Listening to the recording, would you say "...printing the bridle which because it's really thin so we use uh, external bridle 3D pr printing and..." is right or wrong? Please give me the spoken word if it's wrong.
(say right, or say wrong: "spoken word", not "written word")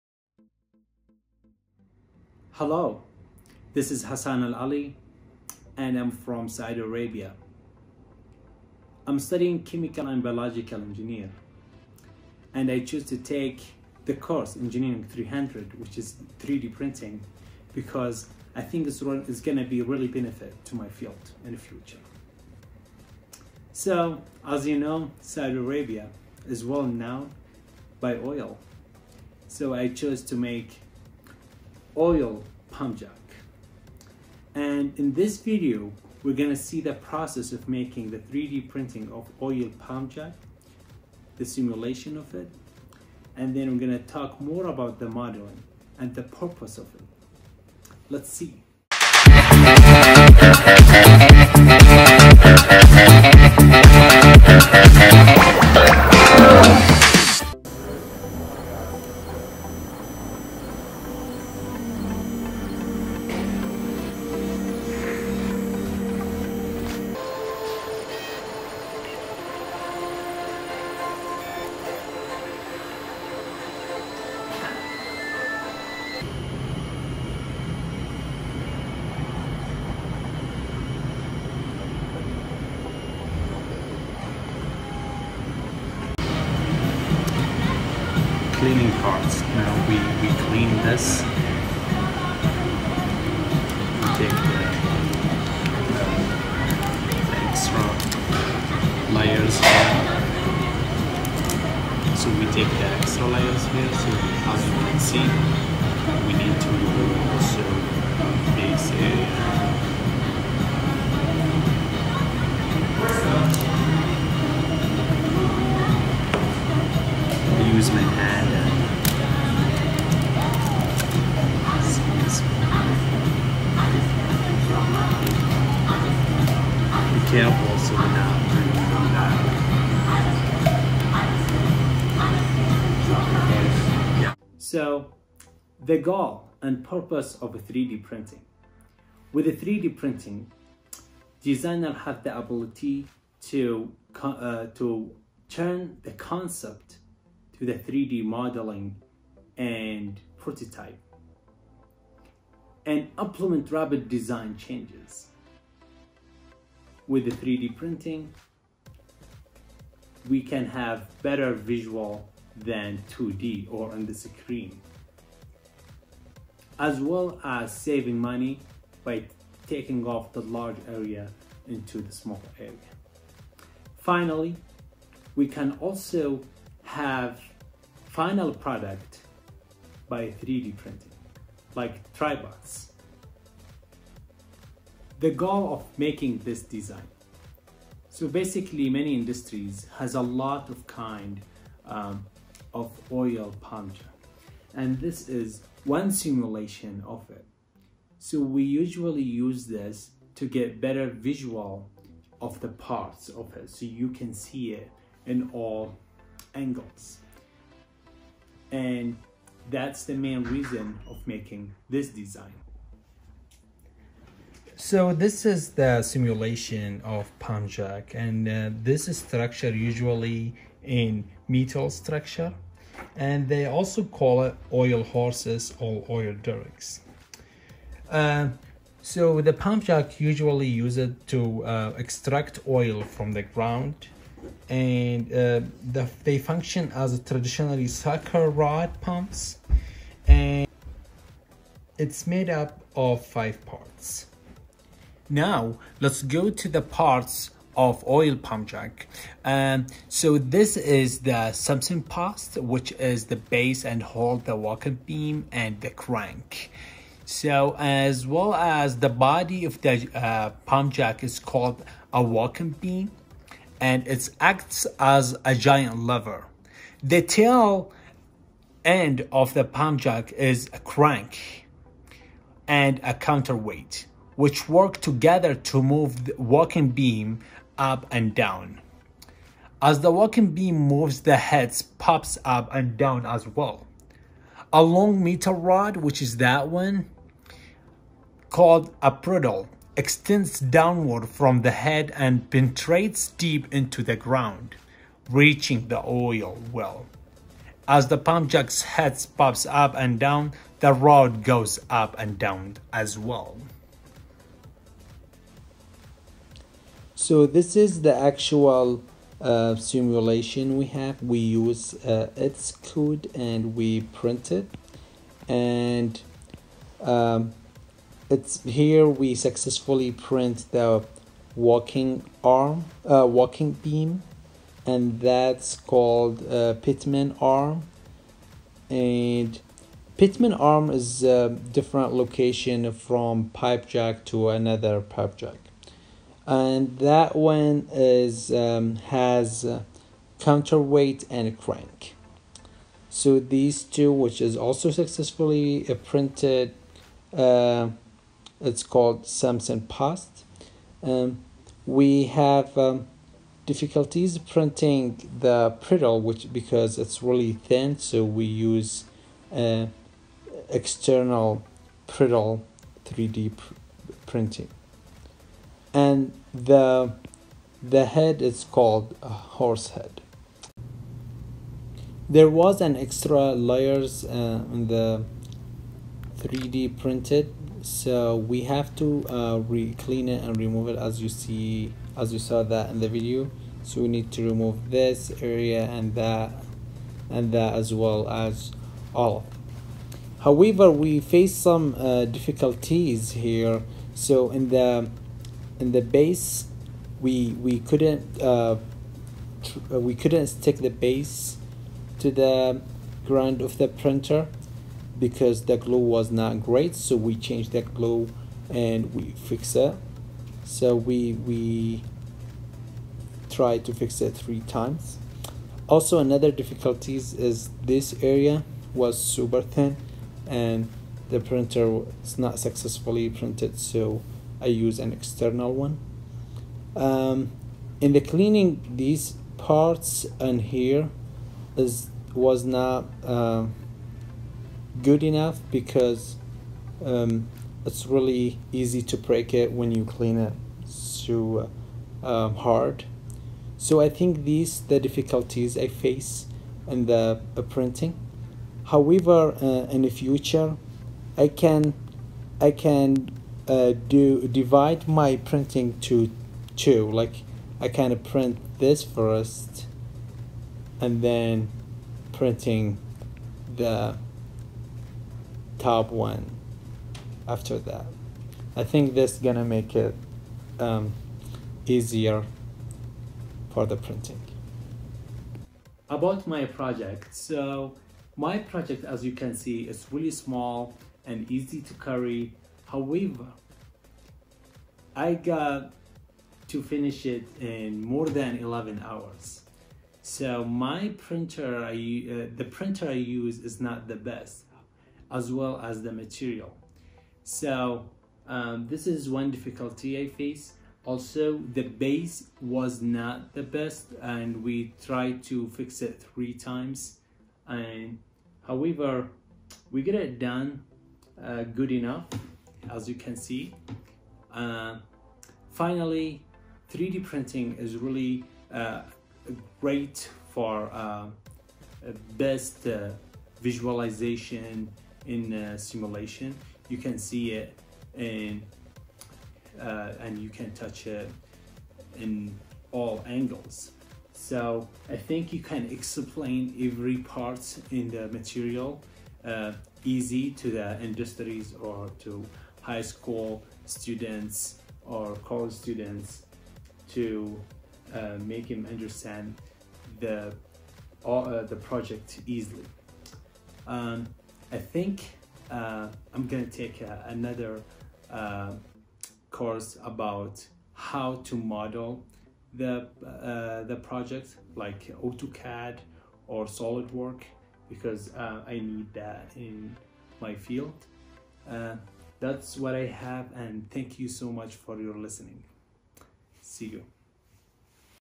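right.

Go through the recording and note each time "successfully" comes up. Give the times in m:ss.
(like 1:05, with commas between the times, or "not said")
5:19, 5:44, 7:02.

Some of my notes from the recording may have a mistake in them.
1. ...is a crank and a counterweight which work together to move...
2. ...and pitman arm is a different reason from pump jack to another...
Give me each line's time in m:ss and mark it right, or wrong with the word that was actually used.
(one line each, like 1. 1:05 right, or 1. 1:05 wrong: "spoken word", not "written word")
1. 4:30 right
2. 5:28 wrong: "location", not "reason".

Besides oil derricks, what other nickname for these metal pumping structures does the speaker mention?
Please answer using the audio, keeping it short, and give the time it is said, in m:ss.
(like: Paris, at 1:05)
Oil horses, at 3:44.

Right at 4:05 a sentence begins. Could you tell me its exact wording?
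Now let's go to the parts of oil pump jack.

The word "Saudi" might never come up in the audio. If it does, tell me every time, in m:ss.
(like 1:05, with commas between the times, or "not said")
0:06, 0:25.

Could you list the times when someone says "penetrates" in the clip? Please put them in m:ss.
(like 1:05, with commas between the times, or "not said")
4:52.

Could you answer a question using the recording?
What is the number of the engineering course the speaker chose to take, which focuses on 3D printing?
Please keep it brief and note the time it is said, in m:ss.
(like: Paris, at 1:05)
300, at 0:15.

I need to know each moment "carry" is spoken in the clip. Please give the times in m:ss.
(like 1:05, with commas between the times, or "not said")
8:01.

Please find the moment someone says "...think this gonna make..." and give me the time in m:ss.
7:48.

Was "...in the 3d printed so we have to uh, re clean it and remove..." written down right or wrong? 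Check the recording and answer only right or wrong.
right.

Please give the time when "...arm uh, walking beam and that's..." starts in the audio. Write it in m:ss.
5:22.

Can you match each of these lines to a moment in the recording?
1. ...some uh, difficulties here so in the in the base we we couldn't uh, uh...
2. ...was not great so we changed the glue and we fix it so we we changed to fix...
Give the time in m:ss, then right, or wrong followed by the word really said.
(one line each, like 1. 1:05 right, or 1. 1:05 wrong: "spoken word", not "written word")
1. 6:31 right
2. 6:45 wrong: "tried", not "changed".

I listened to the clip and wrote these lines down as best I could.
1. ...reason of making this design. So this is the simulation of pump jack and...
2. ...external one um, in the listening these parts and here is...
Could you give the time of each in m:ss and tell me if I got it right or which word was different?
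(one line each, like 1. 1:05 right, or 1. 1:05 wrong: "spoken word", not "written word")
1. 3:30 right
2. 7:05 wrong: "cleaning", not "listening".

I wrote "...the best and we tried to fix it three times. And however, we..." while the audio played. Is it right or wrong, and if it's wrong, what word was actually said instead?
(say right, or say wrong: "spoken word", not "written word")
right.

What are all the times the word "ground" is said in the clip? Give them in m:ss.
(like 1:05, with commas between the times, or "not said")
3:53, 4:54, 6:43.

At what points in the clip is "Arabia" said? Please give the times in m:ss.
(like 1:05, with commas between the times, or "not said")
0:06, 0:25.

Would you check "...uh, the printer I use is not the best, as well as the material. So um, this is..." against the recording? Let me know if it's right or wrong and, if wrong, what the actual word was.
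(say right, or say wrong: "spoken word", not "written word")
right.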